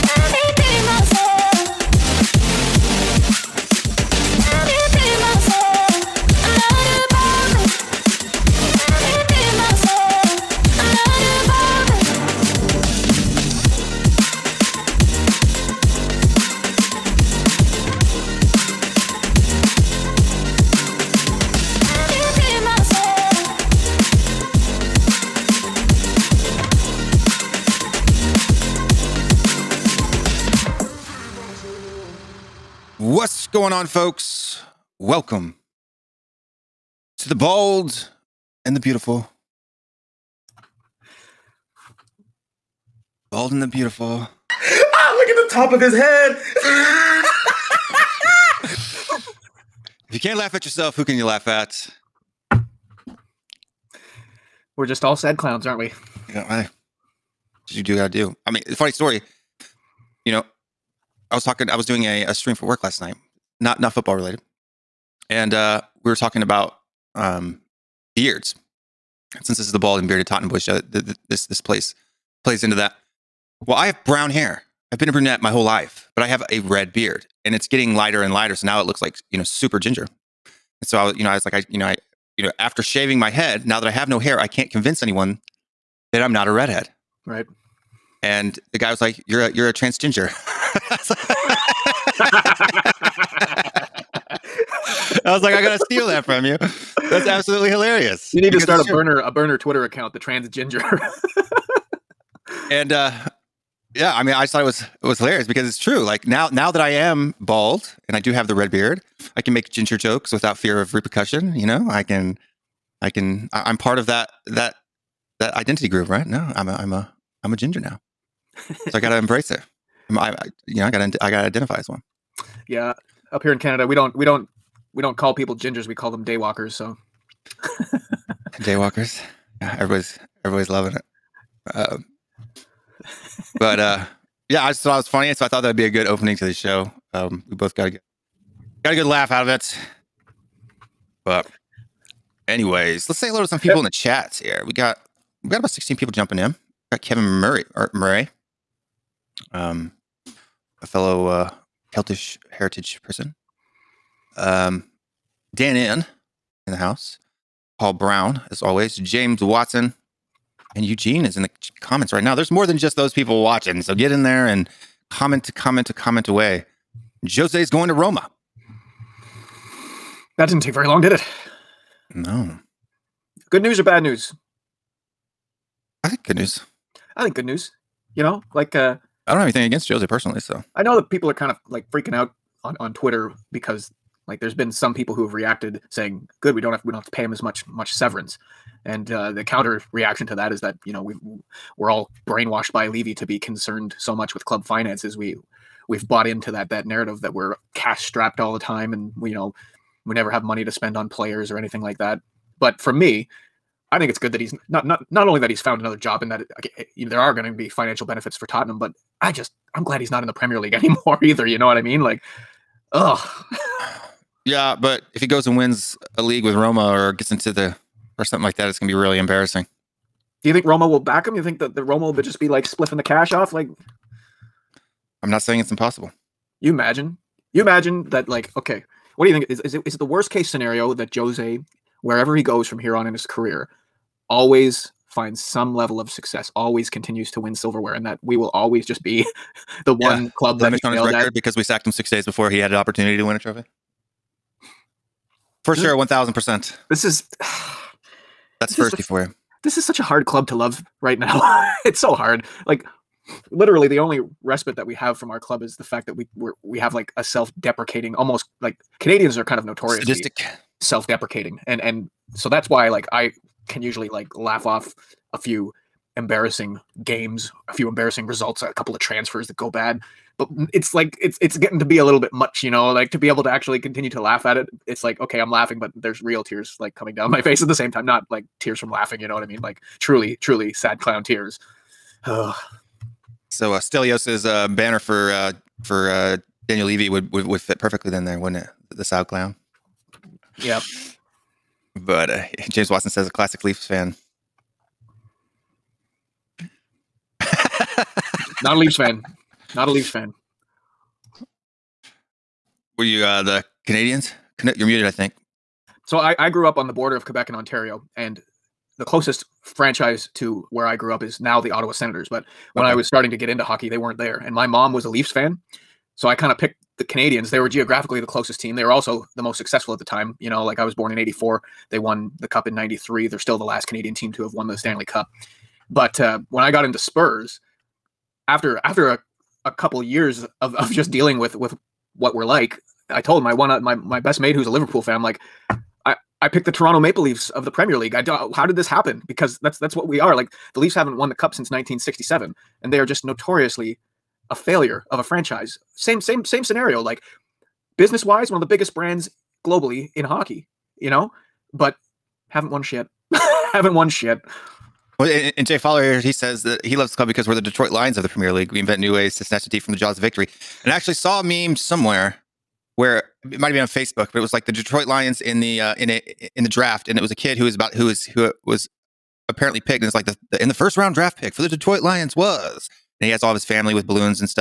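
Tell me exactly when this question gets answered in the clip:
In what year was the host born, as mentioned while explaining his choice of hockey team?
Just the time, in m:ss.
5:21.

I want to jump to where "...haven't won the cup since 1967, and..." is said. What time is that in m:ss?
5:40.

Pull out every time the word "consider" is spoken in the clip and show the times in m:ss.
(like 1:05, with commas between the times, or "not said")
not said.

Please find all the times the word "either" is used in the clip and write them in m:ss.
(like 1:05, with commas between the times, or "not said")
3:31.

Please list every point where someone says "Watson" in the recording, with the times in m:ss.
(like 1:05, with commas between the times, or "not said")
2:39, 4:52.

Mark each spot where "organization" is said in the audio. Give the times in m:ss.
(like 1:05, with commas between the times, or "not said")
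not said.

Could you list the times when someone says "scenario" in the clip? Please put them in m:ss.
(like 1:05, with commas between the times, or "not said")
3:50, 5:46.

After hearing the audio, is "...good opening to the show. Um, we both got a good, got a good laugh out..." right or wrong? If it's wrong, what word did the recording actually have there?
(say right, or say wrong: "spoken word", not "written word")
right.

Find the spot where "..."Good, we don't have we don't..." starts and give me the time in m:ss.
3:06.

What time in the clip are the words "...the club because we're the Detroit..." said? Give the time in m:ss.
5:57.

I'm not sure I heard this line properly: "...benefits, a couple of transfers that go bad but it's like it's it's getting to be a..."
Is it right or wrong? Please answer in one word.
wrong.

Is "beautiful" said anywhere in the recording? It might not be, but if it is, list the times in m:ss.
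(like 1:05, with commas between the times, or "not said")
0:38, 0:43.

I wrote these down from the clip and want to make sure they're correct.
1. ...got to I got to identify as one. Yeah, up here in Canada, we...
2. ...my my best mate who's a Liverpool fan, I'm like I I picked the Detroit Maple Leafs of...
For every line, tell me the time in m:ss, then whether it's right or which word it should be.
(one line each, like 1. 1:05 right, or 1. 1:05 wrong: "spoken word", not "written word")
1. 2:00 right
2. 5:33 wrong: "Toronto", not "Detroit".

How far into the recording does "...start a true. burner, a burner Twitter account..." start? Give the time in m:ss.
1:38.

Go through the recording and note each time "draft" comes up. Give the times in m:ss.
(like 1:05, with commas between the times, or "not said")
6:06, 6:11.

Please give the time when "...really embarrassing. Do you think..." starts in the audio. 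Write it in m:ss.
3:38.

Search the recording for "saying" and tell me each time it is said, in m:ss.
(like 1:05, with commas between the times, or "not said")
3:05, 3:45.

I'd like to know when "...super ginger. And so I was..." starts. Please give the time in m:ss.
1:19.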